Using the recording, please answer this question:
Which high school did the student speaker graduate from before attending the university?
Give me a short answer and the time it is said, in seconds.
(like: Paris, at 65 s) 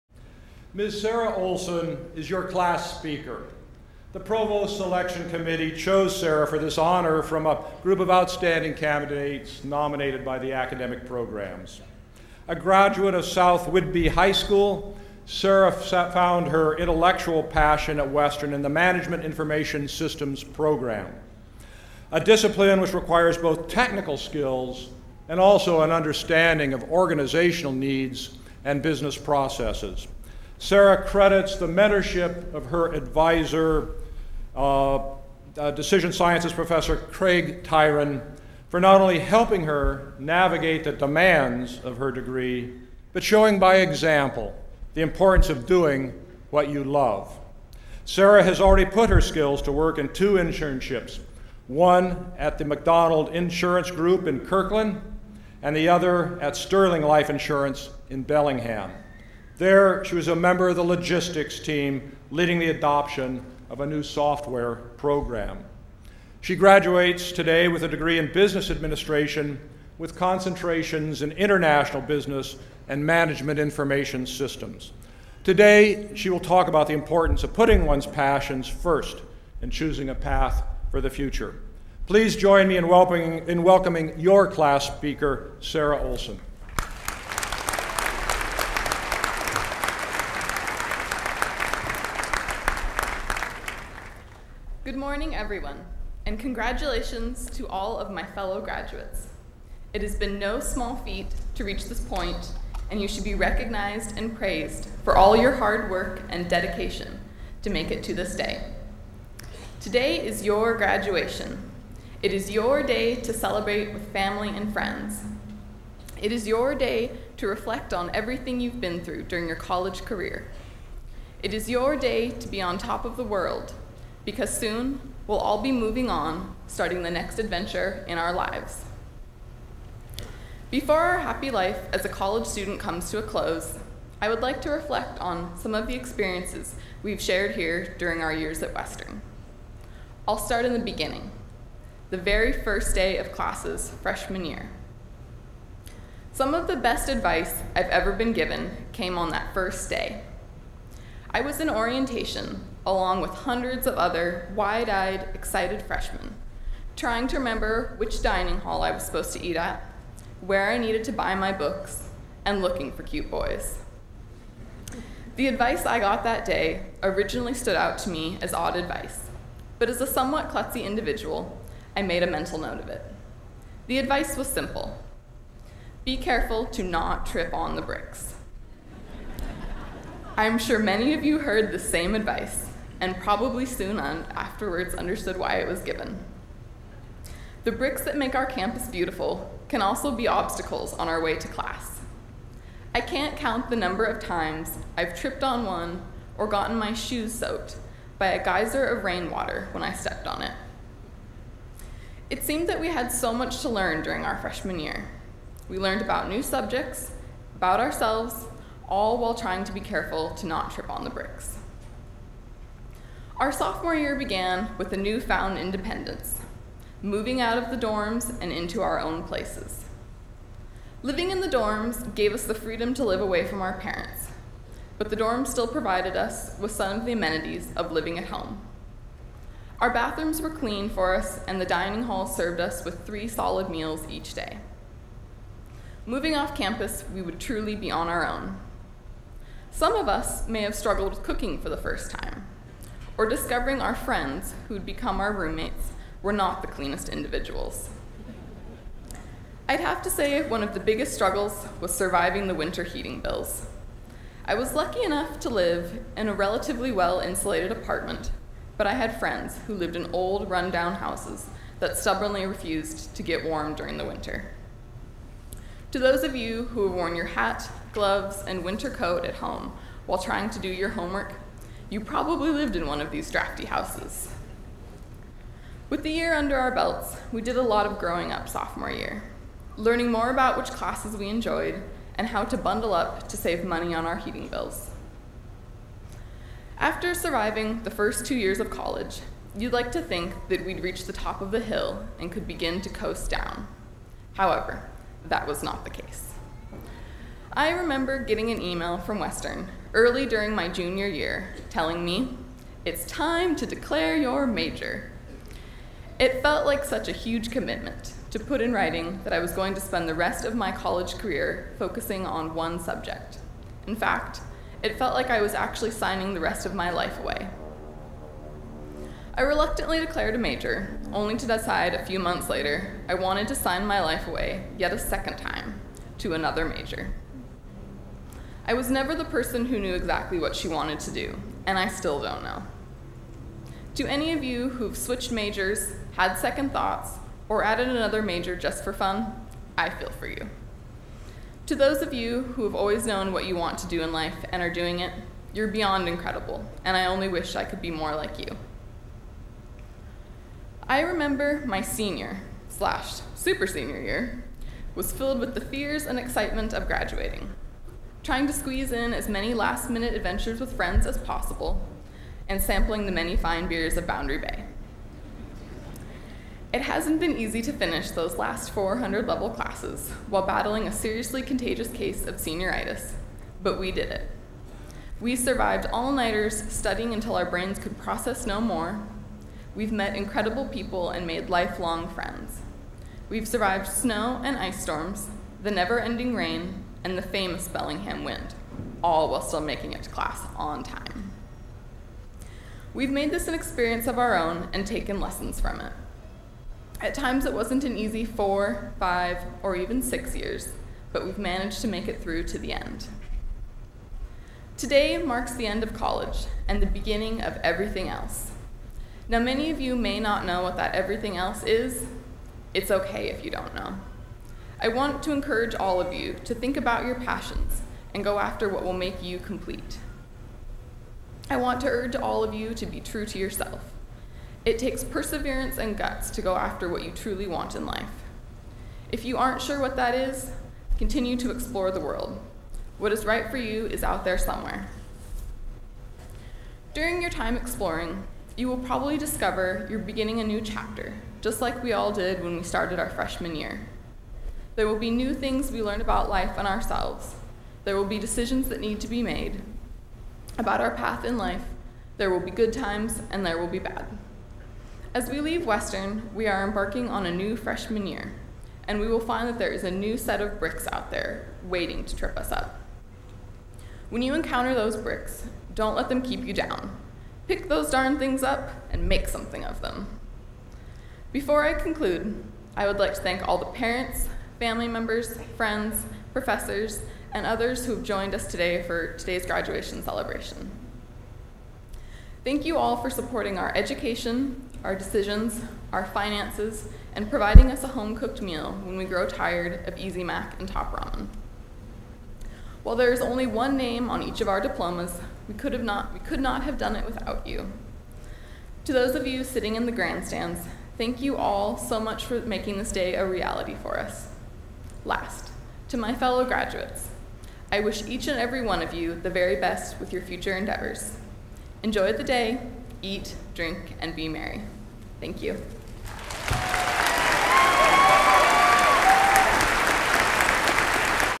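South Whidbey High School, at 13 s.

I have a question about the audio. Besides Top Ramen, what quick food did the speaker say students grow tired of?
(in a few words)
Easy Mac.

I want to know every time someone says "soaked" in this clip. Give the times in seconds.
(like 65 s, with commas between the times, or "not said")
197 s.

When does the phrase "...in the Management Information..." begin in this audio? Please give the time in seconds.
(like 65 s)
18 s.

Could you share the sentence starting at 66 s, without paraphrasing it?
She graduates today with a degree in business administration with concentrations in international business and management information systems.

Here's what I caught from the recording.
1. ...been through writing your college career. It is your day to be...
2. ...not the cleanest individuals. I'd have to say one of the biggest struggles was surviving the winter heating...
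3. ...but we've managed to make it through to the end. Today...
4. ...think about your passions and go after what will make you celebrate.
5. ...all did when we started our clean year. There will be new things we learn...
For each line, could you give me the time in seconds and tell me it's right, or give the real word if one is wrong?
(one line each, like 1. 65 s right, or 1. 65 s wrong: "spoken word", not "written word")
1. 118 s wrong: "during", not "writing"
2. 246 s right
3. 401 s right
4. 416 s wrong: "complete", not "celebrate"
5. 441 s wrong: "freshman", not "clean".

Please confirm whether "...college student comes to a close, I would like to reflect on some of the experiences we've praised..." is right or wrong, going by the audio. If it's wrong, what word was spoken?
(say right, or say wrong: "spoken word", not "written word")
wrong: "shared", not "praised".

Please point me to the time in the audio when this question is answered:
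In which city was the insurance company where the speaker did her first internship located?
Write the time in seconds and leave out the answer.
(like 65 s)
54 s.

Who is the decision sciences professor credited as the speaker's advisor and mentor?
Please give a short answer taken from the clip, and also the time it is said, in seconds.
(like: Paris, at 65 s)
Craig Tyran, at 36 s.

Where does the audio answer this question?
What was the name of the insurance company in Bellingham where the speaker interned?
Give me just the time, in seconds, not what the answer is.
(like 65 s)
56 s.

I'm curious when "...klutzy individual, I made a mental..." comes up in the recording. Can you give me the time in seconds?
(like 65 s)
170 s.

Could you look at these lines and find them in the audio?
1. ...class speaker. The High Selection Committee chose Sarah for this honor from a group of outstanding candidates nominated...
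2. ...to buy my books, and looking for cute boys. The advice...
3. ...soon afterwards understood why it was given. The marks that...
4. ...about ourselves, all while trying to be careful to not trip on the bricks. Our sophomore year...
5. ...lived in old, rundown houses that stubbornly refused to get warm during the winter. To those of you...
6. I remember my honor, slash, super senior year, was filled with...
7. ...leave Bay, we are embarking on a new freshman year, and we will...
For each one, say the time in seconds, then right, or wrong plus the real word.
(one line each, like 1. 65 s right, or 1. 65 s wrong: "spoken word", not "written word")
1. 2 s wrong: "Provost", not "High"
2. 161 s right
3. 183 s wrong: "bricks", not "marks"
4. 207 s right
5. 259 s right
6. 350 s wrong: "senior", not "honor"
7. 455 s wrong: "Western", not "Bay".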